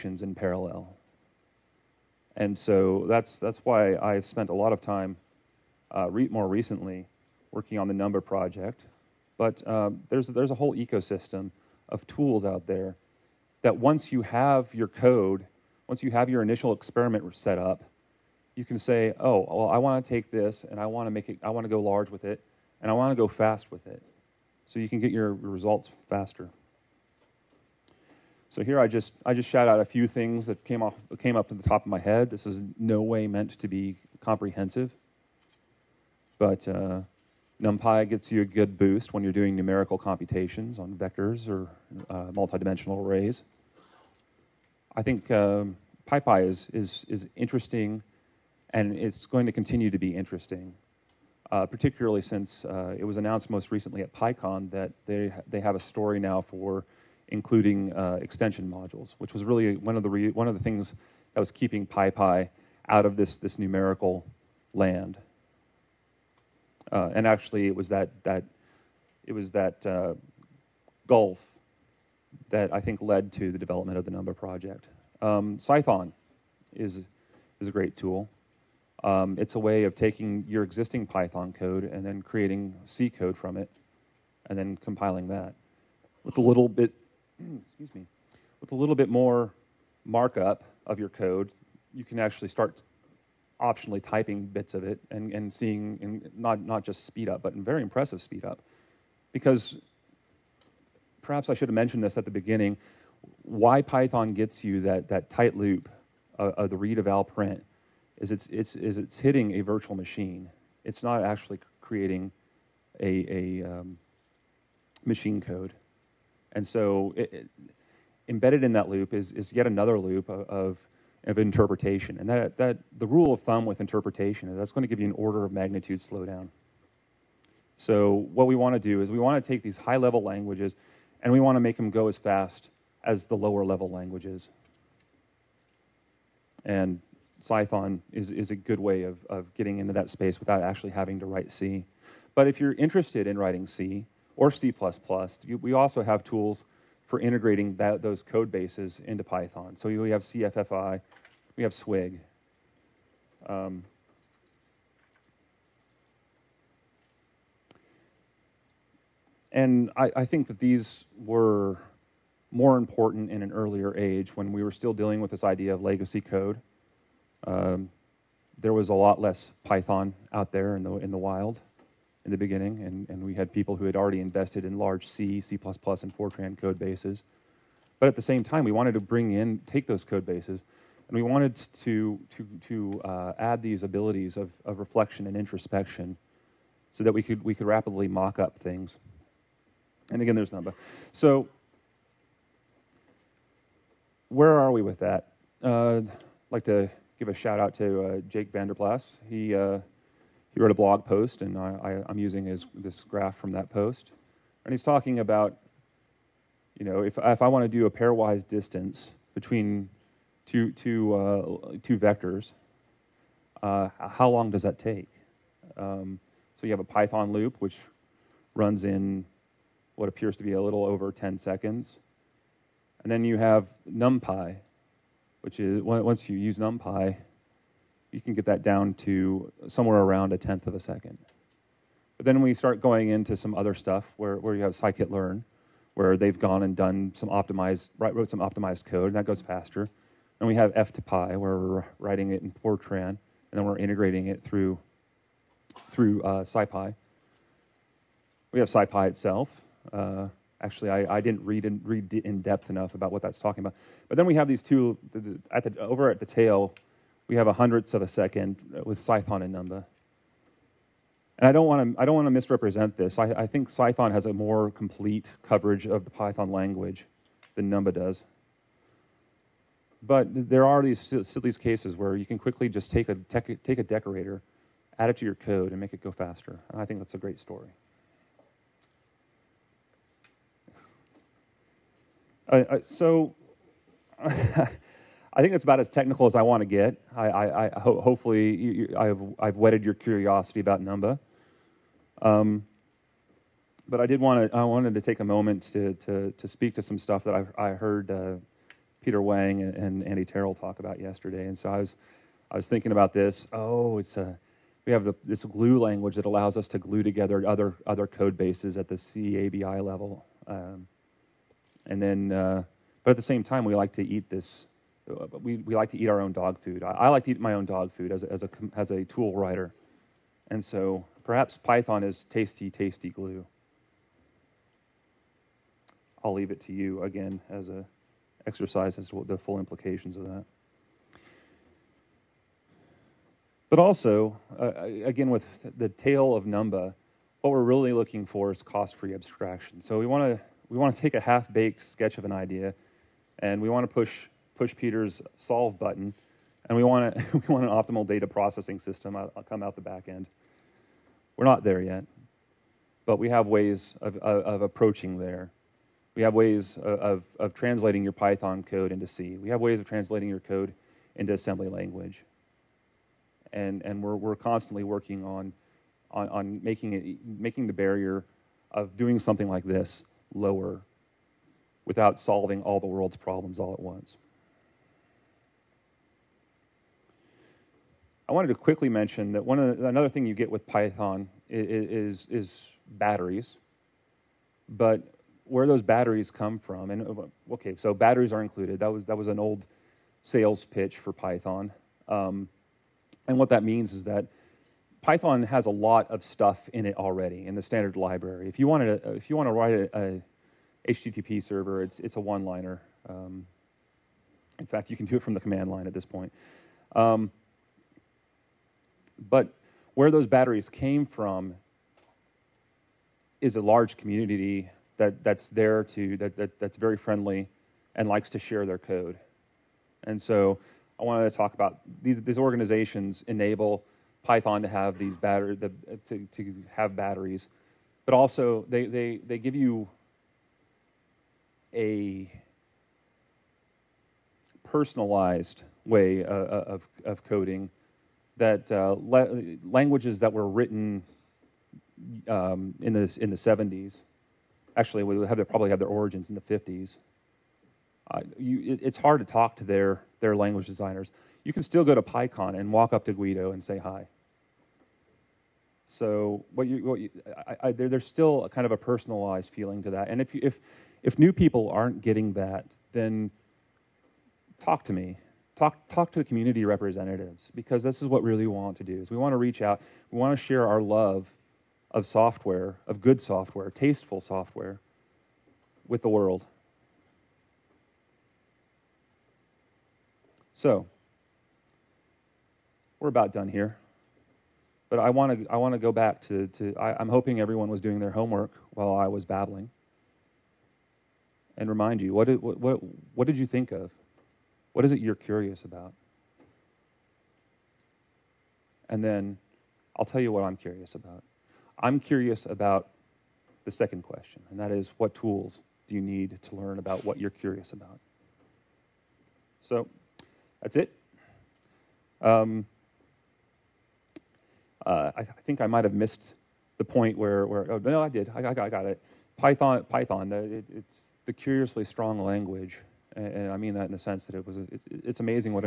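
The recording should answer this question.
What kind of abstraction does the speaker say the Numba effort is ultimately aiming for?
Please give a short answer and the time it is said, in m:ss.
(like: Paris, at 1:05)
cost-free abstraction, at 5:38.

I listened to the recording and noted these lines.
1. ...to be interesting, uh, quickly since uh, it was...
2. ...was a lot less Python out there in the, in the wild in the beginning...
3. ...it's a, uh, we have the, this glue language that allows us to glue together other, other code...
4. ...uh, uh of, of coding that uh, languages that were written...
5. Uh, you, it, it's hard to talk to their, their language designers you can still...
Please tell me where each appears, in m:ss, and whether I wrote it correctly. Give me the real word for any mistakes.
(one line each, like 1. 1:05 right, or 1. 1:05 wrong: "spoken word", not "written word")
1. 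0:49 wrong: "particularly", not "quickly"
2. 2:48 right
3. 5:03 right
4. 7:16 right
5. 7:28 right.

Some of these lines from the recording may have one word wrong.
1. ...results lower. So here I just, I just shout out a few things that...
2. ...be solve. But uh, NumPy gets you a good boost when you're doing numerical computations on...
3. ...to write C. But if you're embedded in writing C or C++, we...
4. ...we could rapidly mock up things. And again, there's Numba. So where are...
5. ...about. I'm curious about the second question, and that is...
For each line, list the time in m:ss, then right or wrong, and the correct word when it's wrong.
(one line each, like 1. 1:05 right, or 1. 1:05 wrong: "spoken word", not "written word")
1. 0:25 wrong: "faster", not "lower"
2. 0:33 wrong: "comprehensive", not "solve"
3. 2:21 wrong: "interested", not "embedded"
4. 3:07 right
5. 8:20 right.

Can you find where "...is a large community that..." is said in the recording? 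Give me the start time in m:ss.
6:53.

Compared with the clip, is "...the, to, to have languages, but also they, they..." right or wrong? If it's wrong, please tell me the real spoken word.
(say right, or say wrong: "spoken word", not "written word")
wrong: "batteries", not "languages".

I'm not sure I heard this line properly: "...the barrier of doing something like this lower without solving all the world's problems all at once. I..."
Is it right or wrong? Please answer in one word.
right.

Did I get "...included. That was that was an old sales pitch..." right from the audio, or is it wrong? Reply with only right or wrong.
right.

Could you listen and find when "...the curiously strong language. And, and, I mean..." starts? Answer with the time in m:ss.
8:41.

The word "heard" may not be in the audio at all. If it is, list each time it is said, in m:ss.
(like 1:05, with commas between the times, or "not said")
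4:57.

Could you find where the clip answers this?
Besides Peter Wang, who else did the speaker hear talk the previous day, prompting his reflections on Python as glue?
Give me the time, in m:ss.
5:00.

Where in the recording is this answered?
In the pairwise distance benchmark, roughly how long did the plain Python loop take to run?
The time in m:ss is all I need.
3:40.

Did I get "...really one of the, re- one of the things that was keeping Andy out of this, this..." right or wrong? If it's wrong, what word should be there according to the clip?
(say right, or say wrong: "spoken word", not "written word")
wrong: "PyPy", not "Andy".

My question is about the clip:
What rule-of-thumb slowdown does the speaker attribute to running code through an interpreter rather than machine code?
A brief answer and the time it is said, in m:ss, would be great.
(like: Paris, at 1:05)
an order of magnitude, at 2:05.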